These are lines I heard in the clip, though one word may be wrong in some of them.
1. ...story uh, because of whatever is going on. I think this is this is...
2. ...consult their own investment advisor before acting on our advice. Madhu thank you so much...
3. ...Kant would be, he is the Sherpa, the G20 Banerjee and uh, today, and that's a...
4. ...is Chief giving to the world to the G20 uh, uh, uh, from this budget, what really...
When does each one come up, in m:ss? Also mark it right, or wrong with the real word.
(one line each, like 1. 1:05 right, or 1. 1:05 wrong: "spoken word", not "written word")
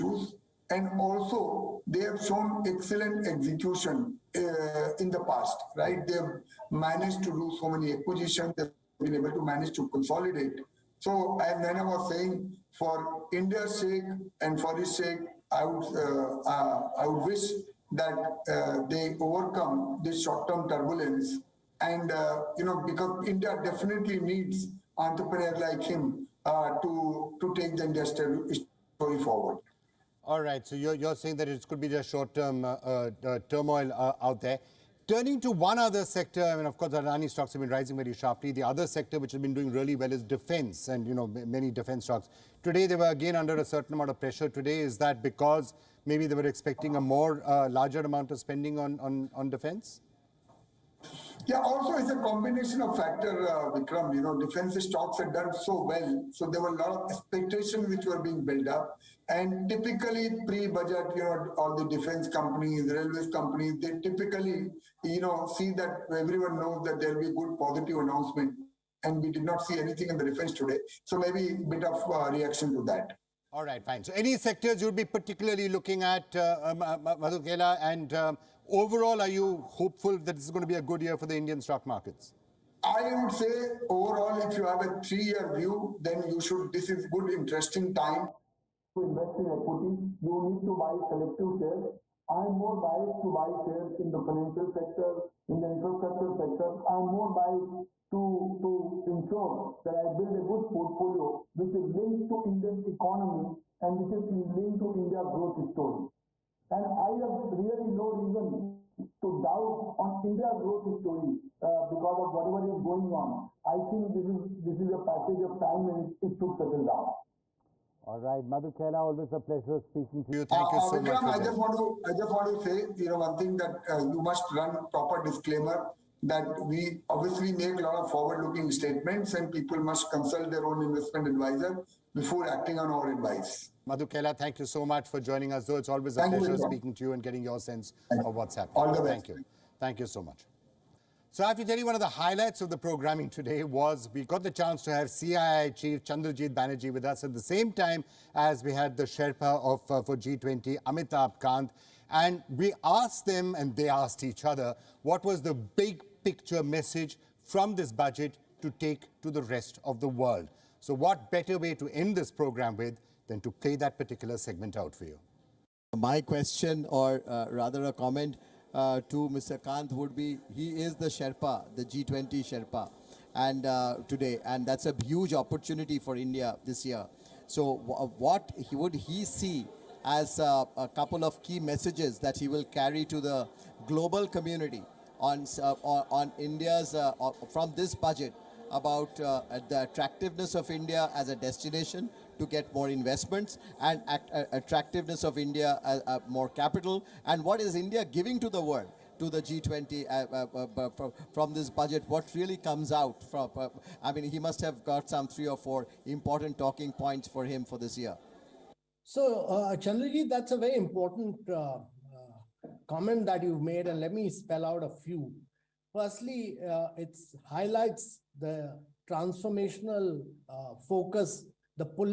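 1. 1:50 right
2. 2:10 right
3. 2:49 wrong: "Sherpa", not "Banerjee"
4. 3:17 wrong: "India", not "Chief".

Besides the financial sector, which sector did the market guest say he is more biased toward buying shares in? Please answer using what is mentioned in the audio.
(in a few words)
infrastructure.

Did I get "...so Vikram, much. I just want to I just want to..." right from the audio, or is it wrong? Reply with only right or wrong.
right.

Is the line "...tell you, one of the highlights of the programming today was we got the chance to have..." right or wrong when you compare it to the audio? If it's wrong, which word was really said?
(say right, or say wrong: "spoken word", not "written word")
right.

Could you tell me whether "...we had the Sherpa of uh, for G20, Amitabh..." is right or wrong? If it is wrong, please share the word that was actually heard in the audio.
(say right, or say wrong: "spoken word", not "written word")
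right.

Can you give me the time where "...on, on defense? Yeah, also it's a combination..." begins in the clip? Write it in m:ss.
0:48.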